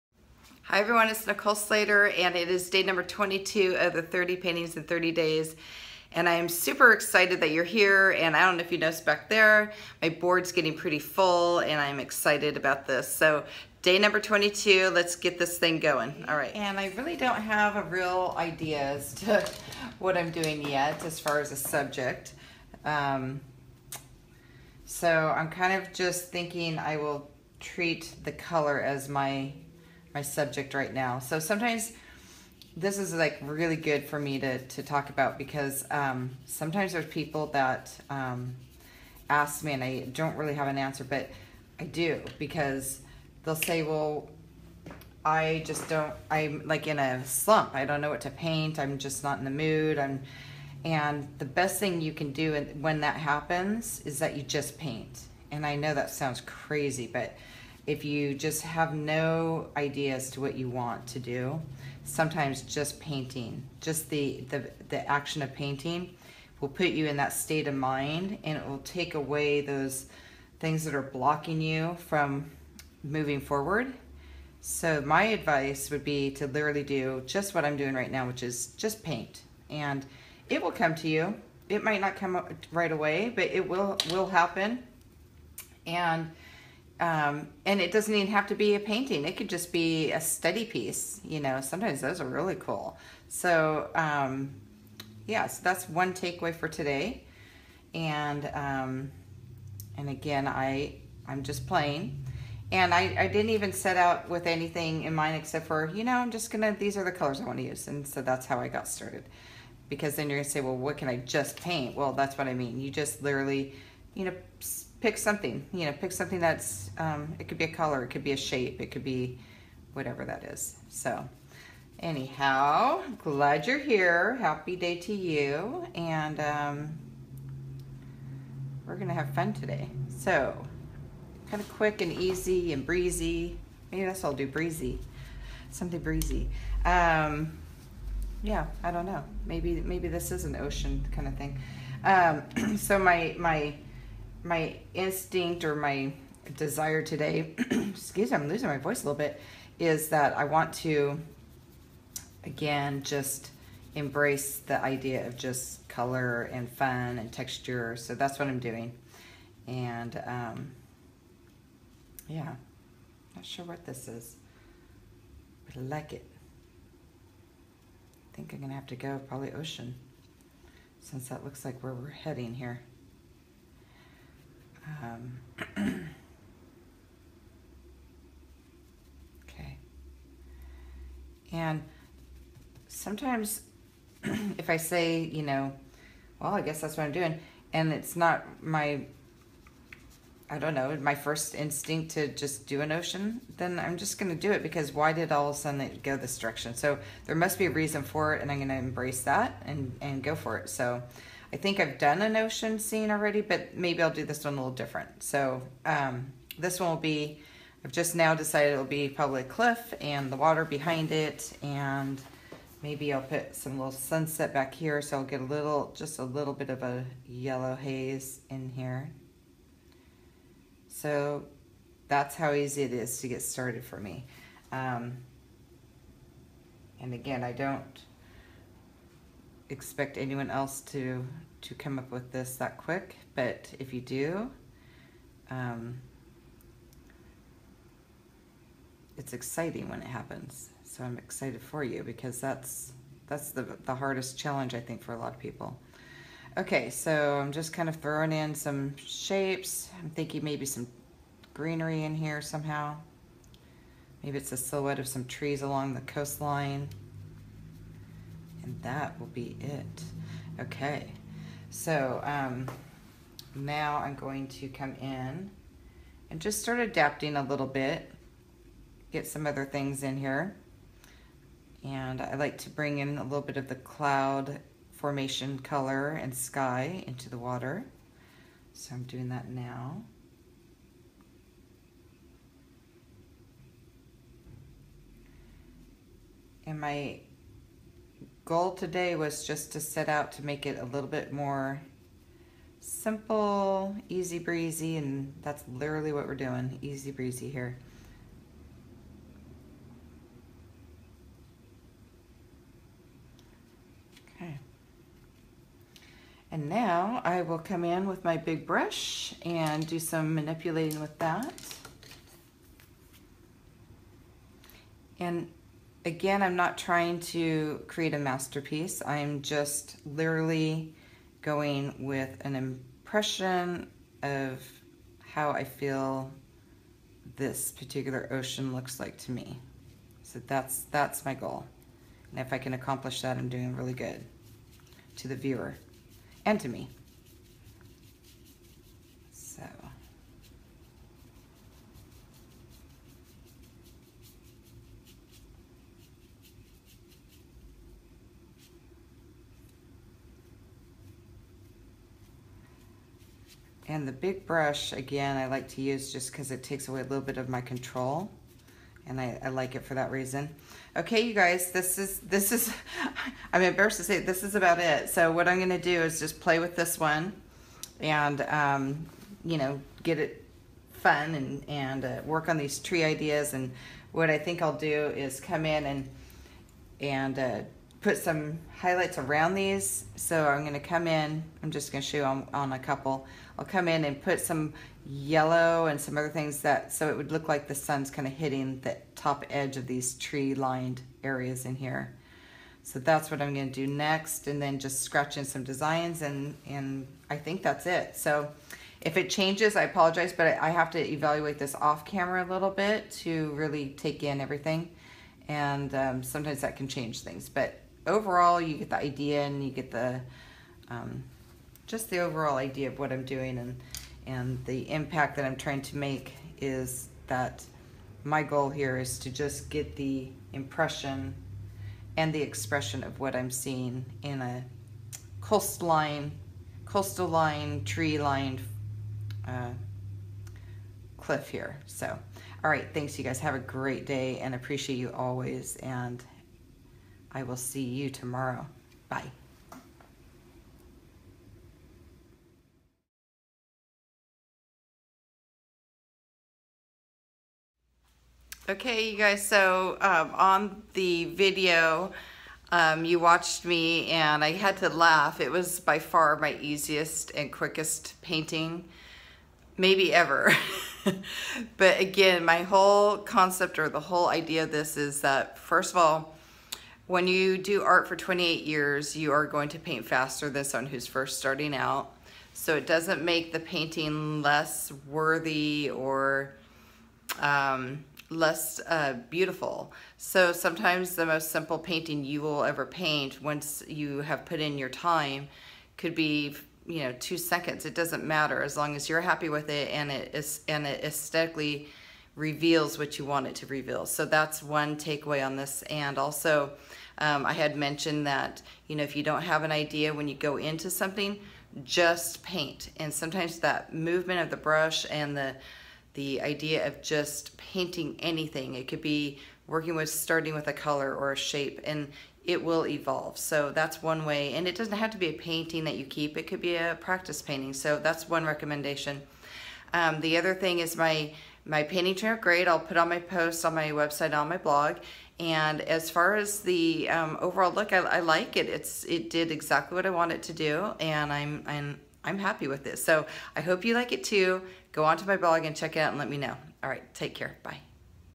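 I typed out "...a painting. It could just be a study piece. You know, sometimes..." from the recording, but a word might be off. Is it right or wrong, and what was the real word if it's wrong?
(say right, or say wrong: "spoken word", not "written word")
right.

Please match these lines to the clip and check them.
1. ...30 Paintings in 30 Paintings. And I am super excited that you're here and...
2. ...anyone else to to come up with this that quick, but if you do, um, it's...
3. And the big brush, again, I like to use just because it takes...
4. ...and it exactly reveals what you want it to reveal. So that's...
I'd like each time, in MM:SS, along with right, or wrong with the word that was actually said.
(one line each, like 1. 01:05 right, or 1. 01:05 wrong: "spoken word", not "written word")
1. 00:04 wrong: "Days", not "Paintings"
2. 03:50 right
3. 05:53 right
4. 08:10 wrong: "aesthetically", not "exactly".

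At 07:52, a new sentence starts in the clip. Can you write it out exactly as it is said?
So it doesn't make the painting less worthy or um, less uh, beautiful.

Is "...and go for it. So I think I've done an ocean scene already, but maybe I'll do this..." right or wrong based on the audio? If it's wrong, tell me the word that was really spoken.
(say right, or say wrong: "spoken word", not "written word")
right.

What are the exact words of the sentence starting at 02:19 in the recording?
Maybe, maybe this is an ocean kind of thing.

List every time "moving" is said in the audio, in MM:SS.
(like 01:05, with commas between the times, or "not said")
01:13.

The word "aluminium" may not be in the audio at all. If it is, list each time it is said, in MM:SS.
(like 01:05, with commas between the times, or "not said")
not said.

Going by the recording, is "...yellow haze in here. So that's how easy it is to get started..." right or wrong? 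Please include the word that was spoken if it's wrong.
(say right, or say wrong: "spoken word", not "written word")
right.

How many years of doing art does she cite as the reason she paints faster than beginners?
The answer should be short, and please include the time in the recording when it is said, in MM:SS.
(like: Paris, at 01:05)
28, at 07:48.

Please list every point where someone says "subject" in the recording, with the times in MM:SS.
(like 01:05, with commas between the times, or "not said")
00:21, 00:30.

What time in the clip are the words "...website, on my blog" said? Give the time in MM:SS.
08:43.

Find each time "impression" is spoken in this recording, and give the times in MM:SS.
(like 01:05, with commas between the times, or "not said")
05:22, 07:00.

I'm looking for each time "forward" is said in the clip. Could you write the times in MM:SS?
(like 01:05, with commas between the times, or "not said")
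01:13.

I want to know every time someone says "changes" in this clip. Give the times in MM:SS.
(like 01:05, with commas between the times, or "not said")
06:39, 06:46.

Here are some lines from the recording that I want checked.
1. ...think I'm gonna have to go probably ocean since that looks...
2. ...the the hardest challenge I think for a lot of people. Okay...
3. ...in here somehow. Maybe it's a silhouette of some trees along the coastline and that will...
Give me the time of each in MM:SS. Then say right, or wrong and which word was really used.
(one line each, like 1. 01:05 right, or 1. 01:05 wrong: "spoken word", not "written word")
1. 02:48 right
2. 04:03 right
3. 04:12 right.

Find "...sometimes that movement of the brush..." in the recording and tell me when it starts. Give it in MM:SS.
08:23.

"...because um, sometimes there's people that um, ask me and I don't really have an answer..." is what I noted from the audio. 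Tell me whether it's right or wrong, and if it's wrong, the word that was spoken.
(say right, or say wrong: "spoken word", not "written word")
right.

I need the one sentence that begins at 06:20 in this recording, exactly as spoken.
So I'm gonna come in, I'm just gonna show on, on a couple.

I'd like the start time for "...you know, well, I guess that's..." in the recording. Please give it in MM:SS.
03:05.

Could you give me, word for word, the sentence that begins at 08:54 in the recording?
Go onto my blog and check it out and let me know.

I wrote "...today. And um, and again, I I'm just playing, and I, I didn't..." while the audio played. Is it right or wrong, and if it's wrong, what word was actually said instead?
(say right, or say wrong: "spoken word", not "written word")
right.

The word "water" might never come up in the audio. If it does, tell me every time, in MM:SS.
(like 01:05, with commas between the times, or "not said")
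03:30, 04:37.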